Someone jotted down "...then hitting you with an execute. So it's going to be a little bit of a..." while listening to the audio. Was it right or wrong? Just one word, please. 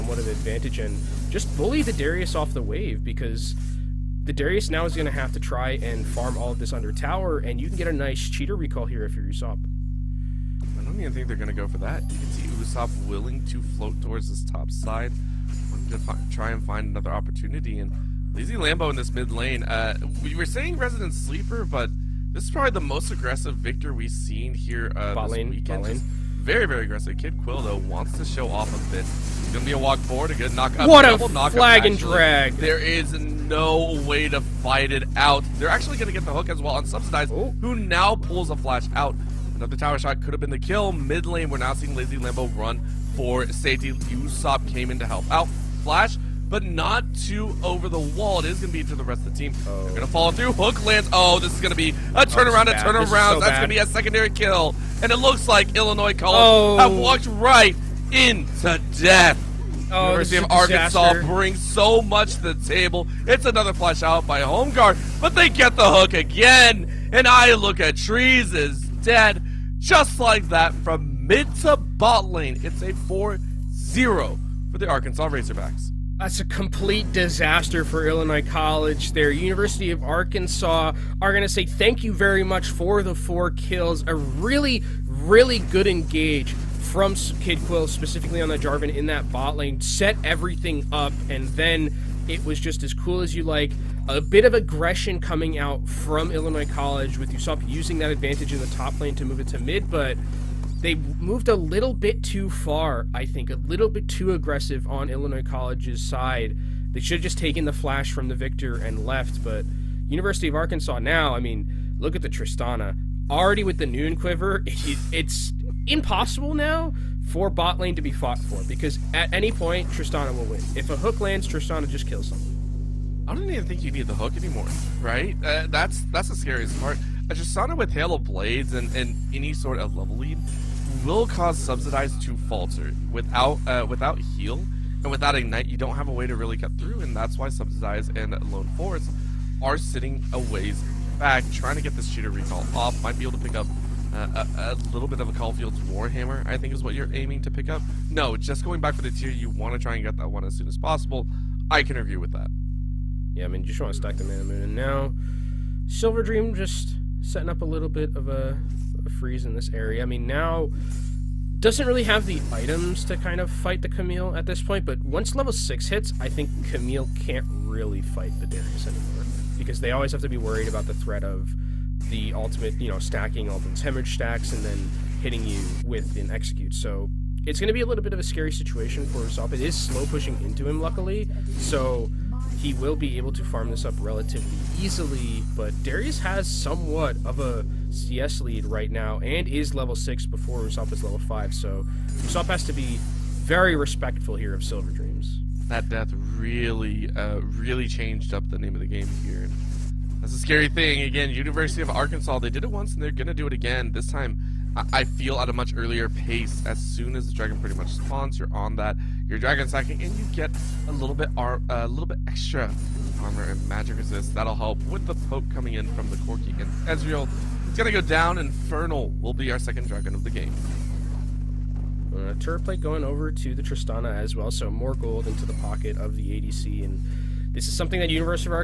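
right.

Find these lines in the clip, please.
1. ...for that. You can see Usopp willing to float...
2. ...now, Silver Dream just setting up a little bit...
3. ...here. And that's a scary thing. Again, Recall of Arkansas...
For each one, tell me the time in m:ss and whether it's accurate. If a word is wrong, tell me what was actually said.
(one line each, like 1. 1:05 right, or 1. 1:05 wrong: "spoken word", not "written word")
1. 0:11 right
2. 2:34 right
3. 3:19 wrong: "University", not "Recall".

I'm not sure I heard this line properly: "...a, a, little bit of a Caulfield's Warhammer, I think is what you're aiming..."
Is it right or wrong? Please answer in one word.
right.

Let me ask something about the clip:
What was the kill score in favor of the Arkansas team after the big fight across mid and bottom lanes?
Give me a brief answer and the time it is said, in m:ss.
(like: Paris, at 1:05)
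4-0, at 1:12.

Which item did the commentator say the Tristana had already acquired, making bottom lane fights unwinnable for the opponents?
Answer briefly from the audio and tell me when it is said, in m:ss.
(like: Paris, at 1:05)
Noonquiver, at 1:53.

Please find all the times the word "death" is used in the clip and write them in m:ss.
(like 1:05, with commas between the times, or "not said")
0:58, 3:15.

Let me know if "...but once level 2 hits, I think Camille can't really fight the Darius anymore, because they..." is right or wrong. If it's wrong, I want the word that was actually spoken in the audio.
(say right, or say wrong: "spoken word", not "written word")
wrong: "6", not "2".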